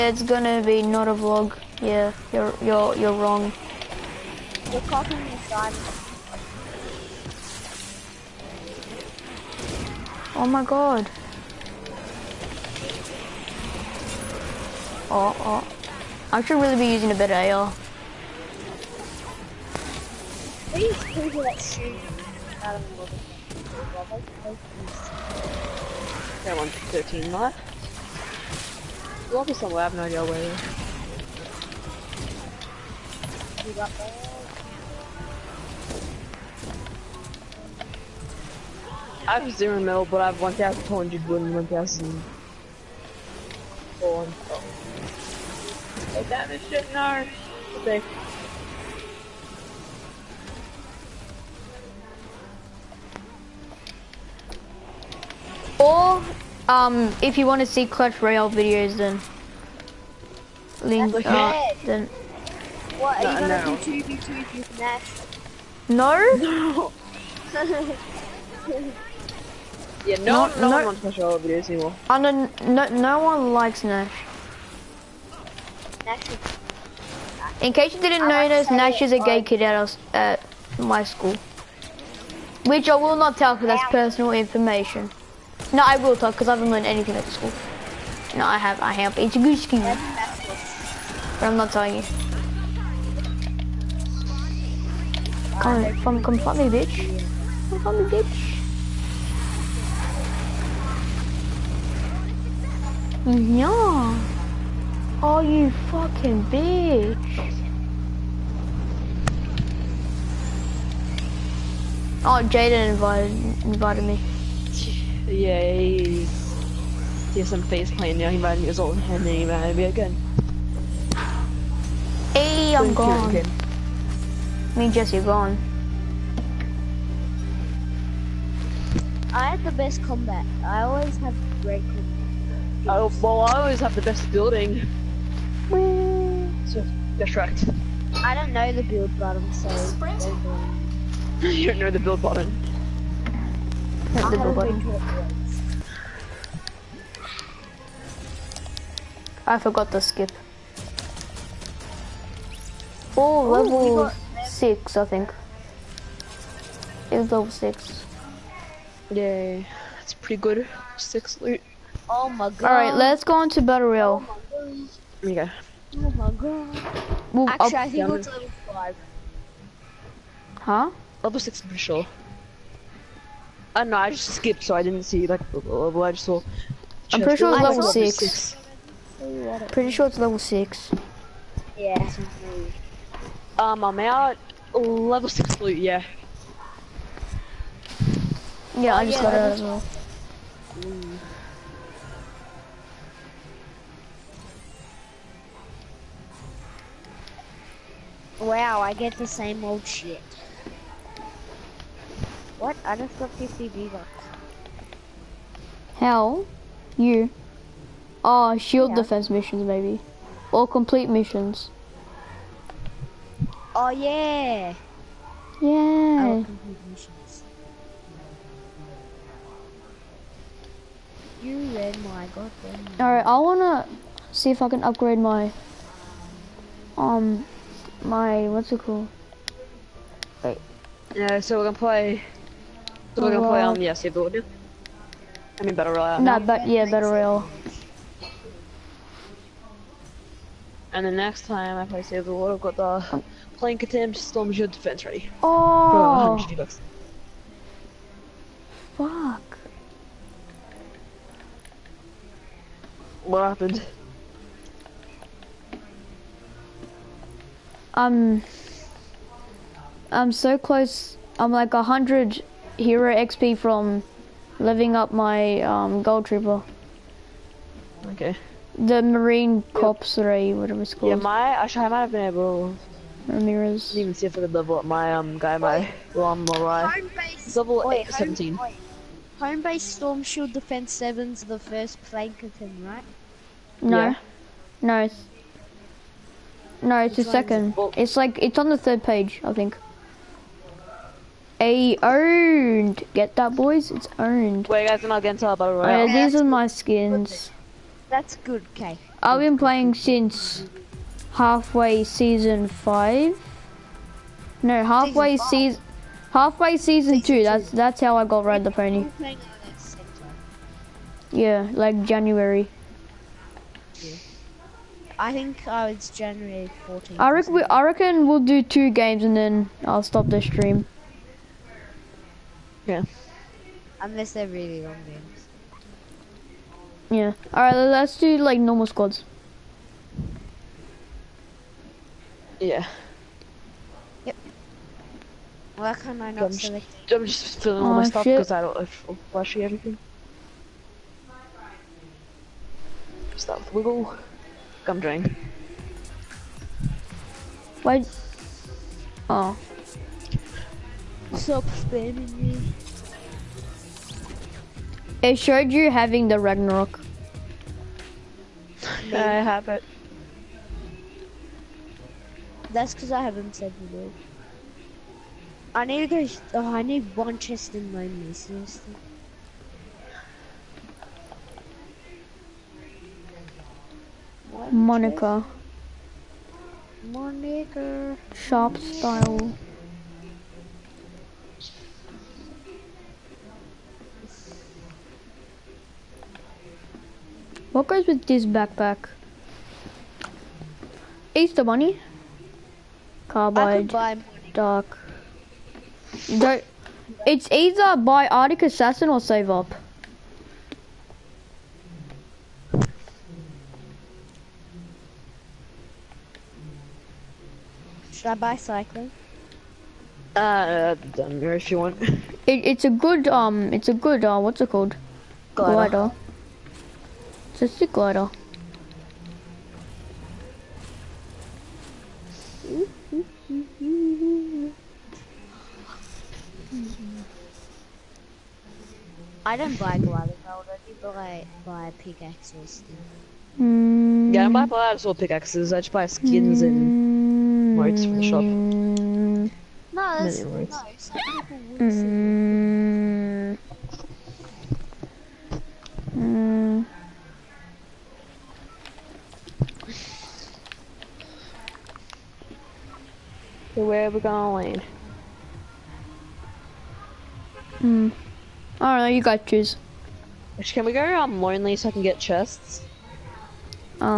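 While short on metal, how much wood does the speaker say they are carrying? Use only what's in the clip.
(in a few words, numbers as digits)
1,200.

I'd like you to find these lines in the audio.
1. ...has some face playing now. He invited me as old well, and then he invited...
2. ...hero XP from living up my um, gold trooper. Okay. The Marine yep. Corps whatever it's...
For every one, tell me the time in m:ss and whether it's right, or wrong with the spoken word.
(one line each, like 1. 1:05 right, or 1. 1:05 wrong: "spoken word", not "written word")
1. 1:57 right
2. 4:22 right.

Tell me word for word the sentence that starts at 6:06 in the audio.
Oh, I need one chest in my missing.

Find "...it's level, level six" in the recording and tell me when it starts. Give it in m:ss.
2:57.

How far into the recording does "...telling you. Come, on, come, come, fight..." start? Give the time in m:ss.
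1:31.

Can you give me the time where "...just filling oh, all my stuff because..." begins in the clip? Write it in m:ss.
5:37.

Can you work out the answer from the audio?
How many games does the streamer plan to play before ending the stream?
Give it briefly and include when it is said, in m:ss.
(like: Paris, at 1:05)
2, at 5:18.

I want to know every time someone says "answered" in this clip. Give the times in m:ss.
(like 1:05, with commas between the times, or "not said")
not said.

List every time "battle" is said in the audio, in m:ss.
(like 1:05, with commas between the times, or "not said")
2:43, 4:55.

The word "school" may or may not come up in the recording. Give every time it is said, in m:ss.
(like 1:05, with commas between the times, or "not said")
1:21, 1:27.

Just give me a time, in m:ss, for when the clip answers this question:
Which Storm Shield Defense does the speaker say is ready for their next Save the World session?
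4:03.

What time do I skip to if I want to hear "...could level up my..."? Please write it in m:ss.
4:34.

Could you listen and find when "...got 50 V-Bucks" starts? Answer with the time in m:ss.
3:23.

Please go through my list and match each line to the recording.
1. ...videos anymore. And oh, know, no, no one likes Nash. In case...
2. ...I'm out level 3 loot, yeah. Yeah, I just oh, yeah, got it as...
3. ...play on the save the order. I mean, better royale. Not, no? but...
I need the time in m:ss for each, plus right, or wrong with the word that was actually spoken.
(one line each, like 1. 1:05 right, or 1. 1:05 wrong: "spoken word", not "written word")
1. 1:11 right
2. 3:03 wrong: "6", not "3"
3. 3:53 right.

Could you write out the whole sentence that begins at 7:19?
No, that's Many no, some people would mm.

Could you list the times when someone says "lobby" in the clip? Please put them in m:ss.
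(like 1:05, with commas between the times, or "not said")
0:29.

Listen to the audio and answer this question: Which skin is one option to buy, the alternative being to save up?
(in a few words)
Arctic Assassin.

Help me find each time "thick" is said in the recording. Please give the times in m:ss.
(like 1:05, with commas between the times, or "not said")
6:57.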